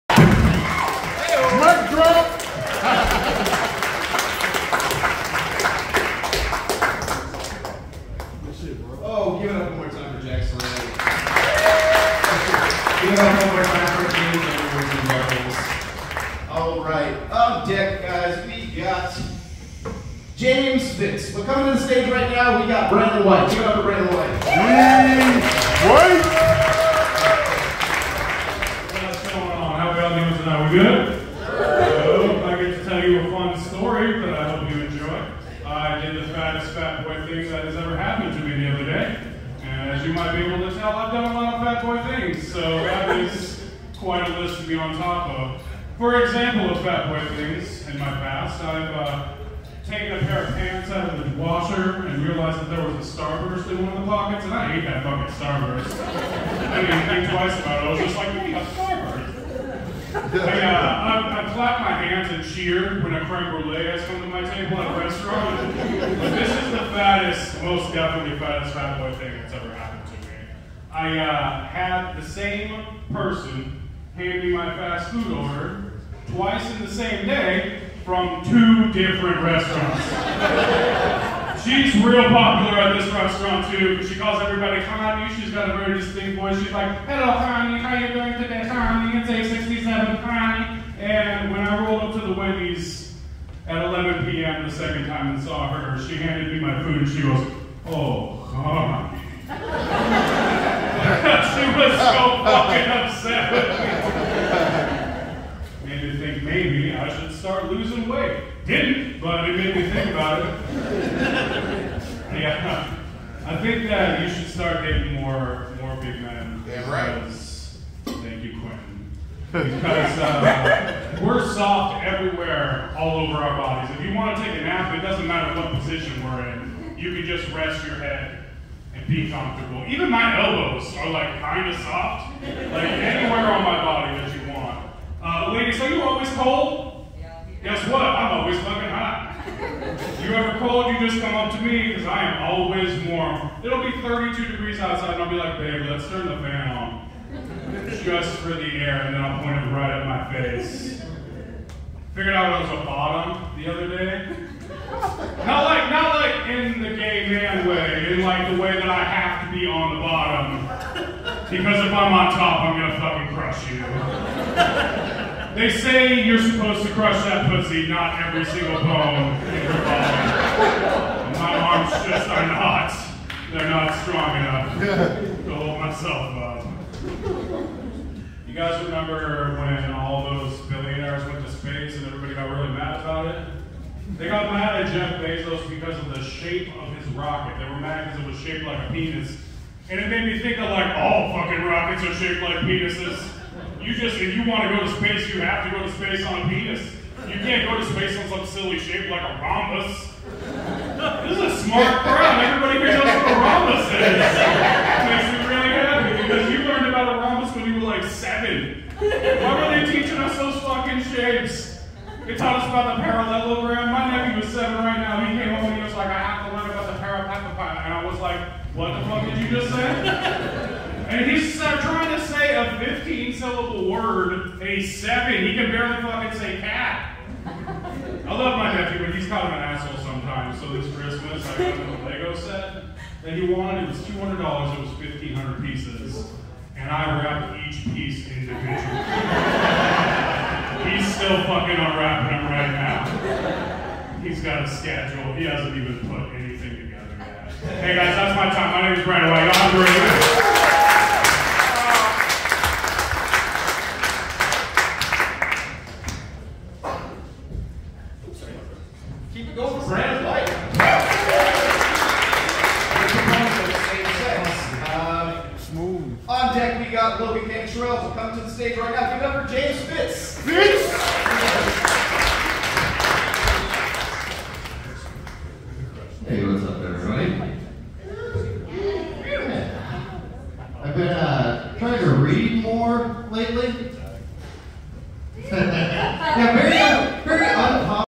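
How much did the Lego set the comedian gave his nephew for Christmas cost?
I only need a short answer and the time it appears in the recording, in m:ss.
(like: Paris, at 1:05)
$200, at 3:54.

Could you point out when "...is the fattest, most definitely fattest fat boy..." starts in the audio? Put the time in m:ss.
1:06.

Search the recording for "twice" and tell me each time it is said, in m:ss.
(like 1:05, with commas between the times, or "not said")
0:57, 1:16.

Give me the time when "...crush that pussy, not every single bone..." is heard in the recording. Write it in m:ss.
2:46.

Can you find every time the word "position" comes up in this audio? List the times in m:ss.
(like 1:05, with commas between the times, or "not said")
2:05.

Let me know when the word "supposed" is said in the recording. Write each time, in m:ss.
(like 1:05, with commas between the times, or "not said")
2:46.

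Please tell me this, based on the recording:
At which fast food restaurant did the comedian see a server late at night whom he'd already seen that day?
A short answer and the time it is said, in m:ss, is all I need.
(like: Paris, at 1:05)
Wendy's, at 1:32.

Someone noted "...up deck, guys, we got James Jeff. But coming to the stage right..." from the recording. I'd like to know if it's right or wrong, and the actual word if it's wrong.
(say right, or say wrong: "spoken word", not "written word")
wrong: "Fitz", not "Jeff".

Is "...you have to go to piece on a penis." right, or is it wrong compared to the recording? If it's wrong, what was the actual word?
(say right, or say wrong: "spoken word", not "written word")
wrong: "space", not "piece".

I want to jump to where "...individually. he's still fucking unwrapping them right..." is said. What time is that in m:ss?
3:58.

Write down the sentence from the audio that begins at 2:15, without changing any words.
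Uh, ladies, are you always cold?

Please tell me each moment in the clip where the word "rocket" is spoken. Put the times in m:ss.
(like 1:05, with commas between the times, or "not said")
3:07, 3:11.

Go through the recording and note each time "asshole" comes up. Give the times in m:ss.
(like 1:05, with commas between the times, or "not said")
3:49.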